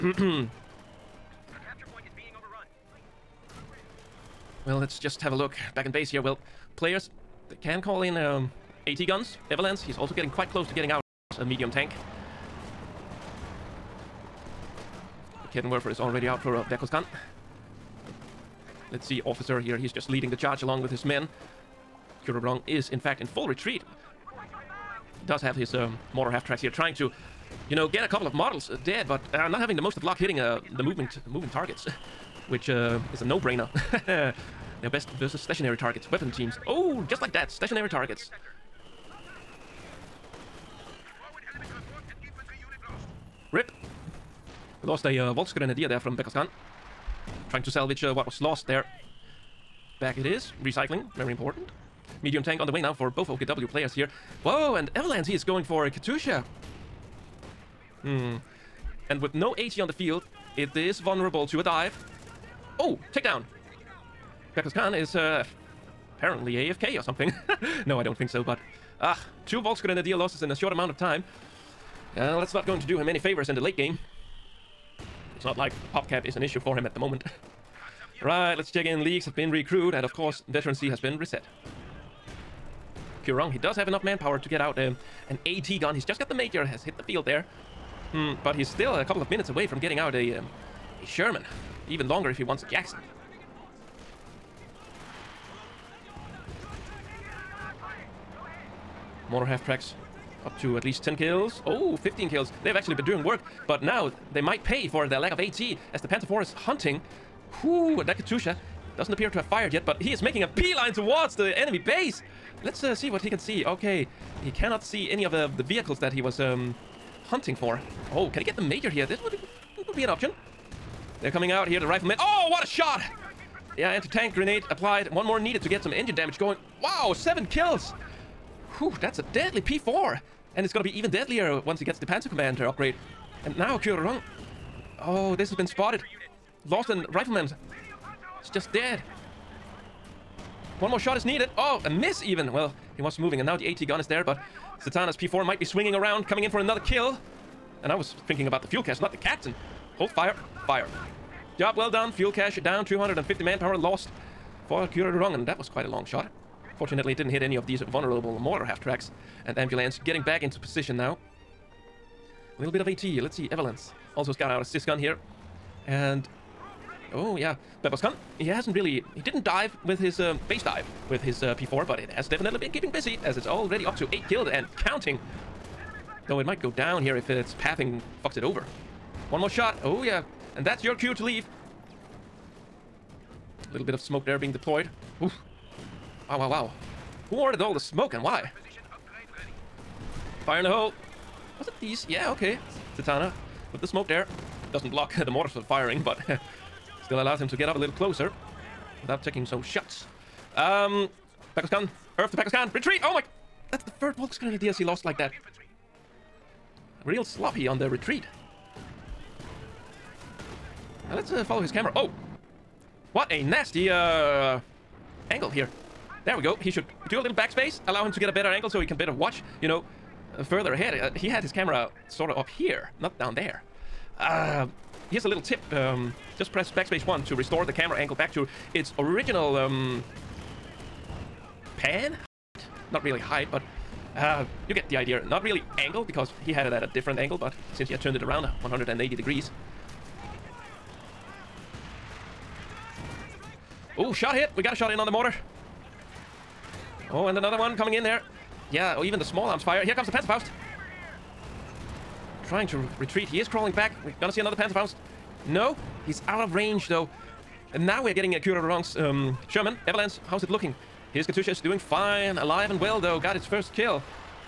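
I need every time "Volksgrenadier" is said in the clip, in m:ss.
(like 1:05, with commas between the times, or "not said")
0:45, 1:09, 3:24.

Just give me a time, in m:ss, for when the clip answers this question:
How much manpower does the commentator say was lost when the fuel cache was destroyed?
2:32.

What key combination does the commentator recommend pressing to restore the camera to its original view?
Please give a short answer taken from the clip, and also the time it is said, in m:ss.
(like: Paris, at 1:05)
Backspace 1, at 3:46.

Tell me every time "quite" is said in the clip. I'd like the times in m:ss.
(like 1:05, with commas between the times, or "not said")
0:10, 2:35.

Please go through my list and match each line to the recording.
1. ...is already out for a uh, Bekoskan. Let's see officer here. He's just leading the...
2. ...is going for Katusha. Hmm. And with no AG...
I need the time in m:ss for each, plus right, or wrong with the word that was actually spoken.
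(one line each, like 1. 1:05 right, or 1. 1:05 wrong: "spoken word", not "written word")
1. 0:15 right
2. 0:55 right.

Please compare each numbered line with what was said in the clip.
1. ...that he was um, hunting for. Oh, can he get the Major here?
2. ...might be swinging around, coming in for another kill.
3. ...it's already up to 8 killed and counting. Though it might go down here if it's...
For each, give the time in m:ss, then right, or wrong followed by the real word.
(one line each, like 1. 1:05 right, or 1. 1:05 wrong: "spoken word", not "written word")
1. 1:55 right
2. 2:25 right
3. 2:53 right.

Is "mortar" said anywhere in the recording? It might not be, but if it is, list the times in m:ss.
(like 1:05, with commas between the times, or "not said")
0:26, 1:39, 2:38, 3:15, 4:05.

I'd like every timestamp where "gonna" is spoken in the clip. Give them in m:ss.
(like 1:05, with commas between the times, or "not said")
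2:10, 4:14.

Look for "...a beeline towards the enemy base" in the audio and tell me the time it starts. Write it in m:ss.
1:50.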